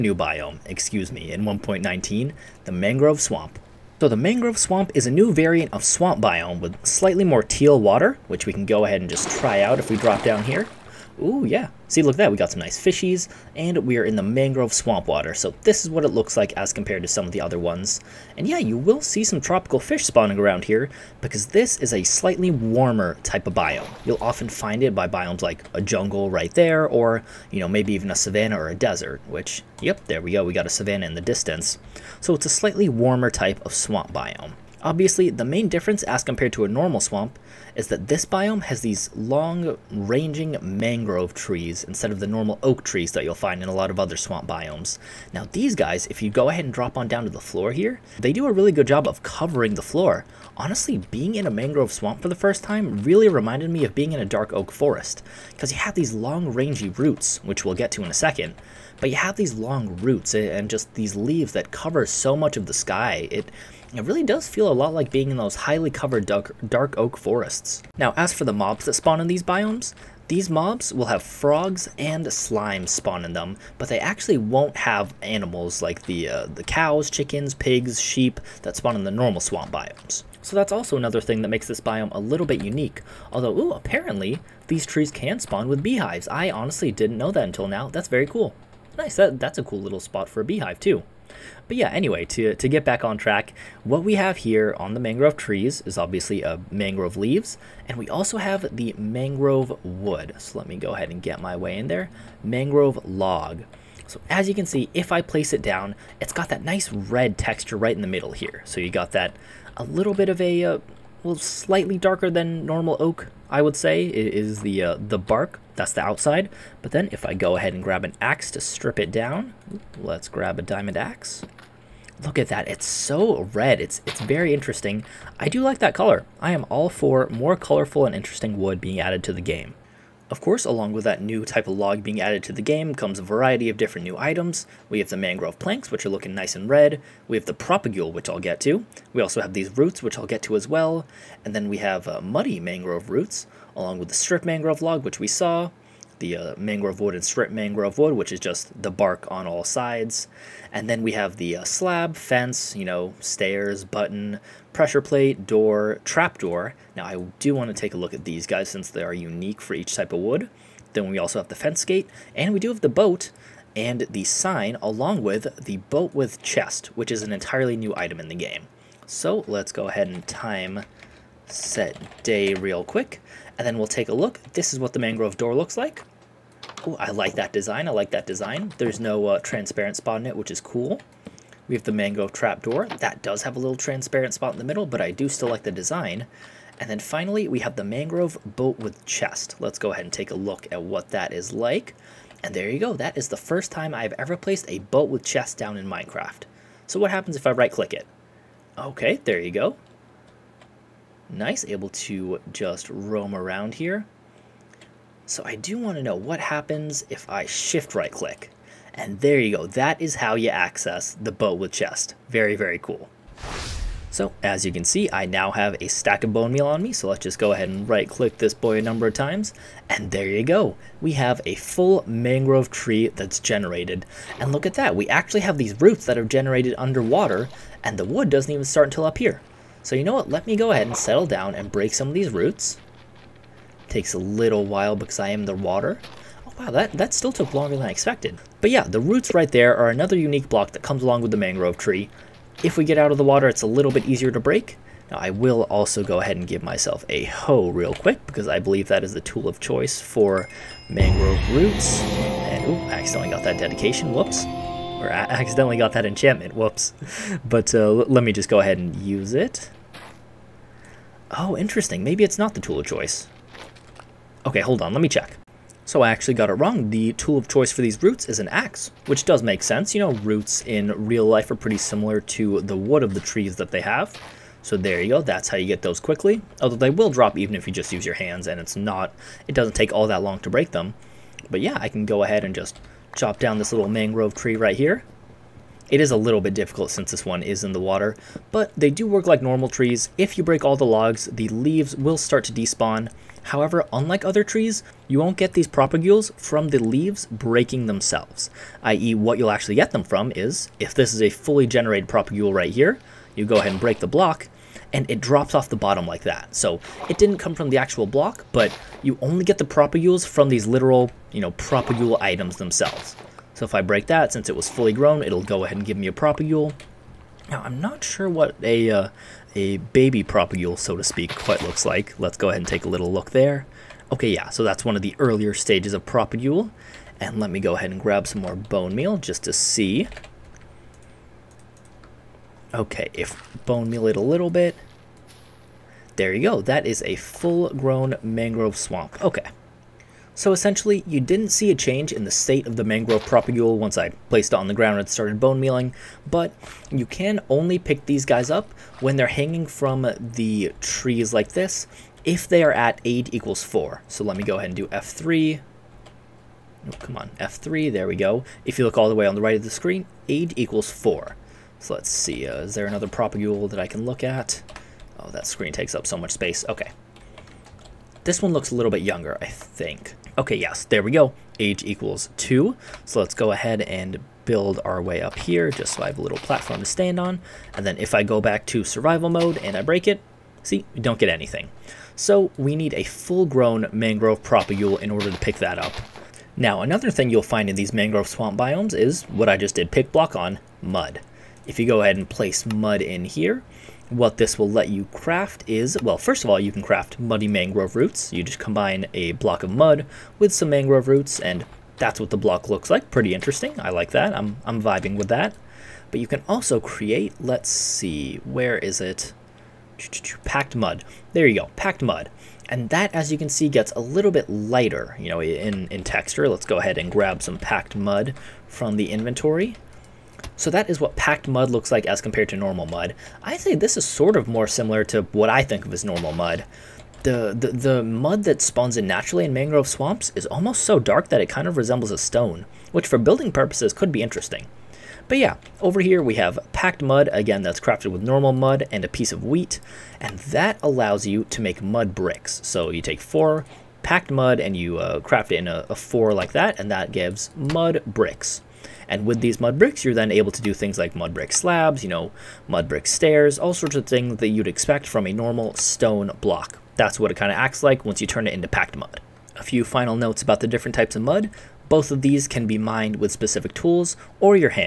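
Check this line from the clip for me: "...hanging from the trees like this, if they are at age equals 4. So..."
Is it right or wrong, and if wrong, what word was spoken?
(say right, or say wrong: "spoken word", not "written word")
right.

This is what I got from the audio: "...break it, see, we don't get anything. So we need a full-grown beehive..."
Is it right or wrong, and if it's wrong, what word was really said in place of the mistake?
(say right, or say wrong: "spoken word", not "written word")
wrong: "mangrove", not "beehive".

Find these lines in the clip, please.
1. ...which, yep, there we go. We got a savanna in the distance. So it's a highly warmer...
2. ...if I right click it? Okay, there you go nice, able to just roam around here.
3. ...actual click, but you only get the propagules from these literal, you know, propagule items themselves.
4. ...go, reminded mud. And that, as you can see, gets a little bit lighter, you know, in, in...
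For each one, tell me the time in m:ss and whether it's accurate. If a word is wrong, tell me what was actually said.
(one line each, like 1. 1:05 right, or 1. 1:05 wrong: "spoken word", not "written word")
1. 0:29 wrong: "slightly", not "highly"
2. 3:17 right
3. 5:07 wrong: "block", not "click"
4. 6:51 wrong: "packed", not "reminded".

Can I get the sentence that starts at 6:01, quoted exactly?
So let's see, uh, is there another propagule that I can look at?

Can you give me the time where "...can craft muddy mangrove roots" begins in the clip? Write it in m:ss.
6:36.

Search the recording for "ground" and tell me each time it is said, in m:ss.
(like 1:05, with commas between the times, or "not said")
5:44.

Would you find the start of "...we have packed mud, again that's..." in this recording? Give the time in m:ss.
7:16.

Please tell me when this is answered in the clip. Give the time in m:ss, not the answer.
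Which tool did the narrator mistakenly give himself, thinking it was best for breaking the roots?
4:07.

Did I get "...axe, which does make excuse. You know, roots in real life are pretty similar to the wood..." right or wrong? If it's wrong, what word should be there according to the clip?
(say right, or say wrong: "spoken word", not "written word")
wrong: "sense", not "excuse".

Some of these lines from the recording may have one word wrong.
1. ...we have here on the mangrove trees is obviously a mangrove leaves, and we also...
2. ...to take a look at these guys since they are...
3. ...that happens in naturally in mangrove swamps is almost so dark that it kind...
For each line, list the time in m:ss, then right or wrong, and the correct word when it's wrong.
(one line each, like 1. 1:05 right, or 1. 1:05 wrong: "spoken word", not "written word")
1. 1:34 right
2. 2:37 right
3. 7:08 wrong: "spawns", not "happens".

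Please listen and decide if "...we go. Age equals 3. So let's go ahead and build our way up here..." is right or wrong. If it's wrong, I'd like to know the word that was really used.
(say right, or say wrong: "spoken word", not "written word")
wrong: "2", not "3".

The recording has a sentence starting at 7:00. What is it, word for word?
So that is what packed mud looks like as compared to normal mud.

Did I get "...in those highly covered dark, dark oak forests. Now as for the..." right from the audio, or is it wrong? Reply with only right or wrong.
right.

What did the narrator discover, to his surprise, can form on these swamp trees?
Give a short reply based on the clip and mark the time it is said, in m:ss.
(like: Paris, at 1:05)
beehives, at 1:25.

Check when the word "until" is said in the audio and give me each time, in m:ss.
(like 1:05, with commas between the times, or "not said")
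1:27, 3:48.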